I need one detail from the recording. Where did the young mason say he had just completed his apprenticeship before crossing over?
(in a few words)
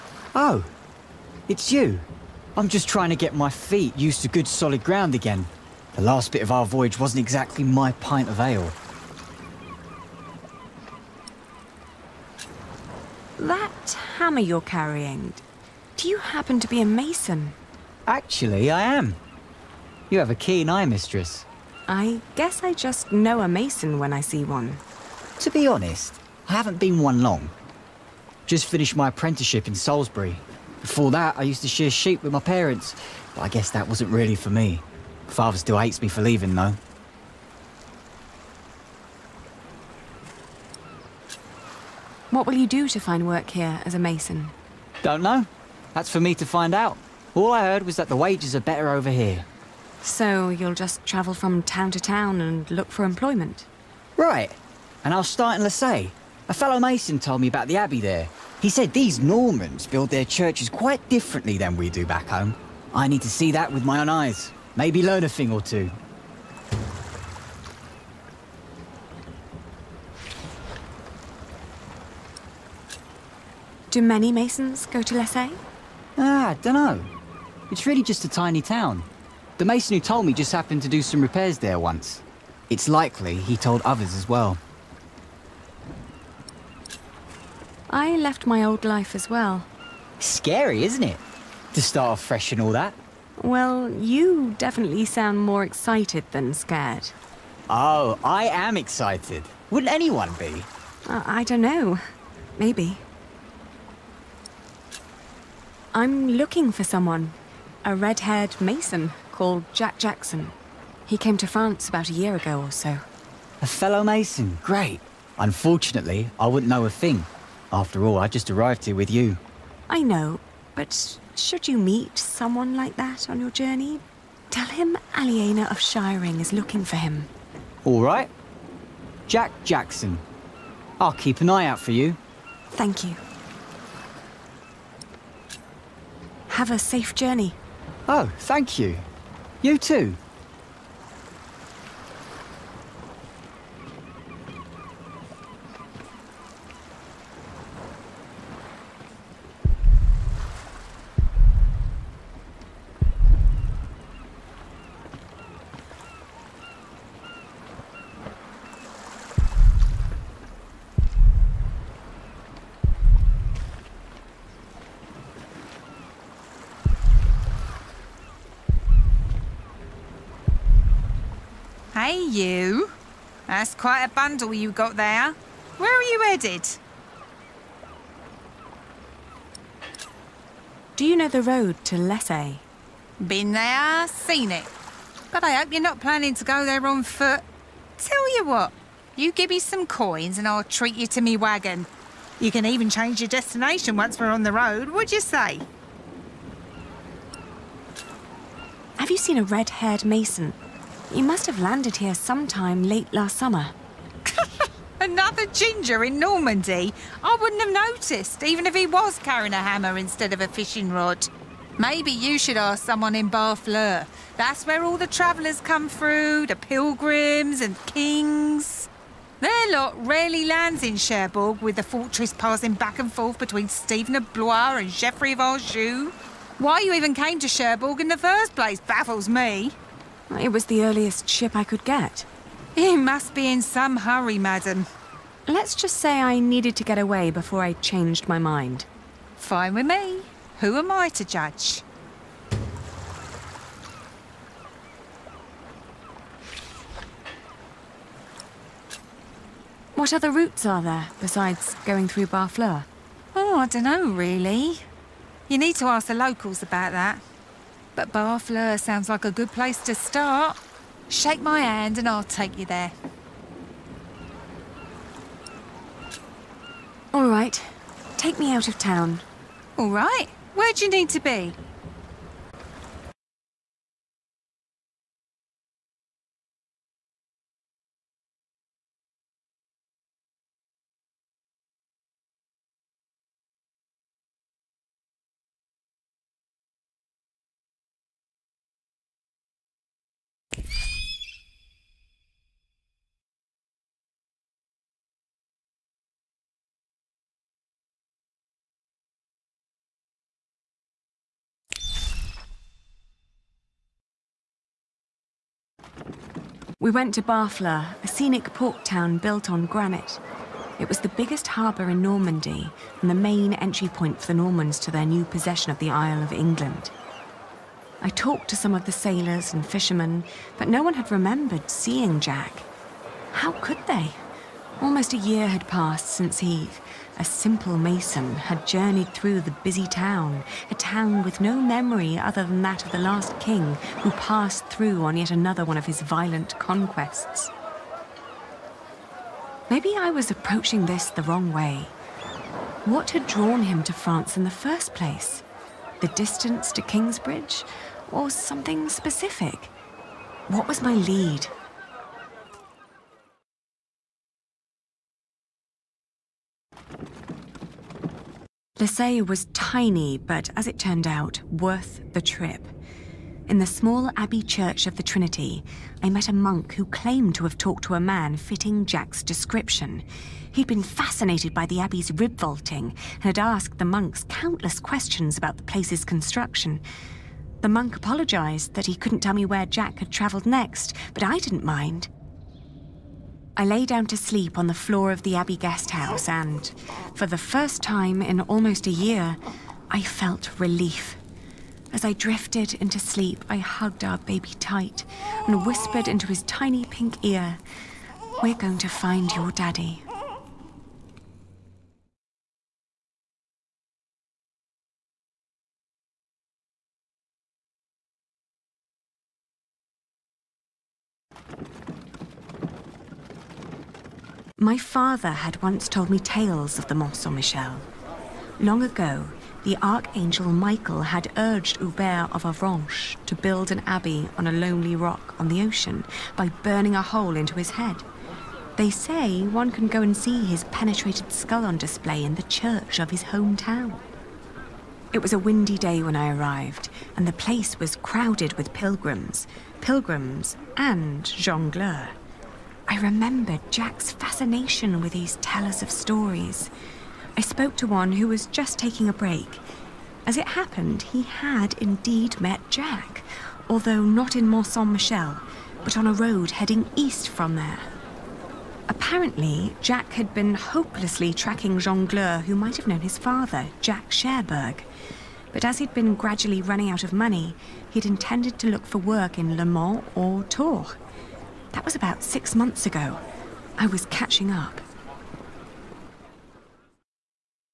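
Salisbury.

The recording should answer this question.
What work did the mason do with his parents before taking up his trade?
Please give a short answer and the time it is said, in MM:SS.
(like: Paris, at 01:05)
Shear sheep, at 00:31.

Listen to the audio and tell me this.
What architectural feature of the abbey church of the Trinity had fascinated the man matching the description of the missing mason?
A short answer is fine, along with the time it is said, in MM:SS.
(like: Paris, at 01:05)
Rib vaulting, at 06:12.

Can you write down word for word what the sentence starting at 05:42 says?
What had drawn him to France in the first place?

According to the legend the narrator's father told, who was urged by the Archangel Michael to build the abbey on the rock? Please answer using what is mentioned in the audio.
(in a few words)
Hubert of Avranches.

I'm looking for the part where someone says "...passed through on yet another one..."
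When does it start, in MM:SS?
05:34.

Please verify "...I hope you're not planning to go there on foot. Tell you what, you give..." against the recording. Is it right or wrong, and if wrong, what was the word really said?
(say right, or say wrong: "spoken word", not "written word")
right.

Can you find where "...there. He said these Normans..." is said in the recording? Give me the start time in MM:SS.
00:58.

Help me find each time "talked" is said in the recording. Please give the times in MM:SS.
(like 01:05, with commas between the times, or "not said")
05:18, 06:07.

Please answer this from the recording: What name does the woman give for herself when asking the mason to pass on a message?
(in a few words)
Aliena of Shiring.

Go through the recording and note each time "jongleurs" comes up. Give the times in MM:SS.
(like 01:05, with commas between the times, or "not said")
07:21, 07:41.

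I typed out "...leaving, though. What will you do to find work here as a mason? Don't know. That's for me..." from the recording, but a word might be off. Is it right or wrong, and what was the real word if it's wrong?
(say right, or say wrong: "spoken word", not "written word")
right.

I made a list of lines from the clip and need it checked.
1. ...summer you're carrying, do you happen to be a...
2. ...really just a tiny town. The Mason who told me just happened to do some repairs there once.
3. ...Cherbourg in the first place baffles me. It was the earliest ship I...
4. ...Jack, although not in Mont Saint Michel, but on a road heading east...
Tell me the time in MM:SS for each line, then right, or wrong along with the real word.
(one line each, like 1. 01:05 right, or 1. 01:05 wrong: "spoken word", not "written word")
1. 00:14 wrong: "hammer", not "summer"
2. 01:17 right
3. 03:47 right
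4. 07:32 right.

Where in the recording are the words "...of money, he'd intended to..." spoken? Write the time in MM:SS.
07:47.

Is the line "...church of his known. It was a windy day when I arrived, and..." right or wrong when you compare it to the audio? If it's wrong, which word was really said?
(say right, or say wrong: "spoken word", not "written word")
wrong: "hometown", not "known".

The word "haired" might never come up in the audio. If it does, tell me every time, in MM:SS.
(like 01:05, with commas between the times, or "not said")
01:47, 03:19.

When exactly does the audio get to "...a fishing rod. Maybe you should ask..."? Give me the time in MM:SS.
03:30.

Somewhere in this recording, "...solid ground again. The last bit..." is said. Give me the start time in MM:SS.
00:04.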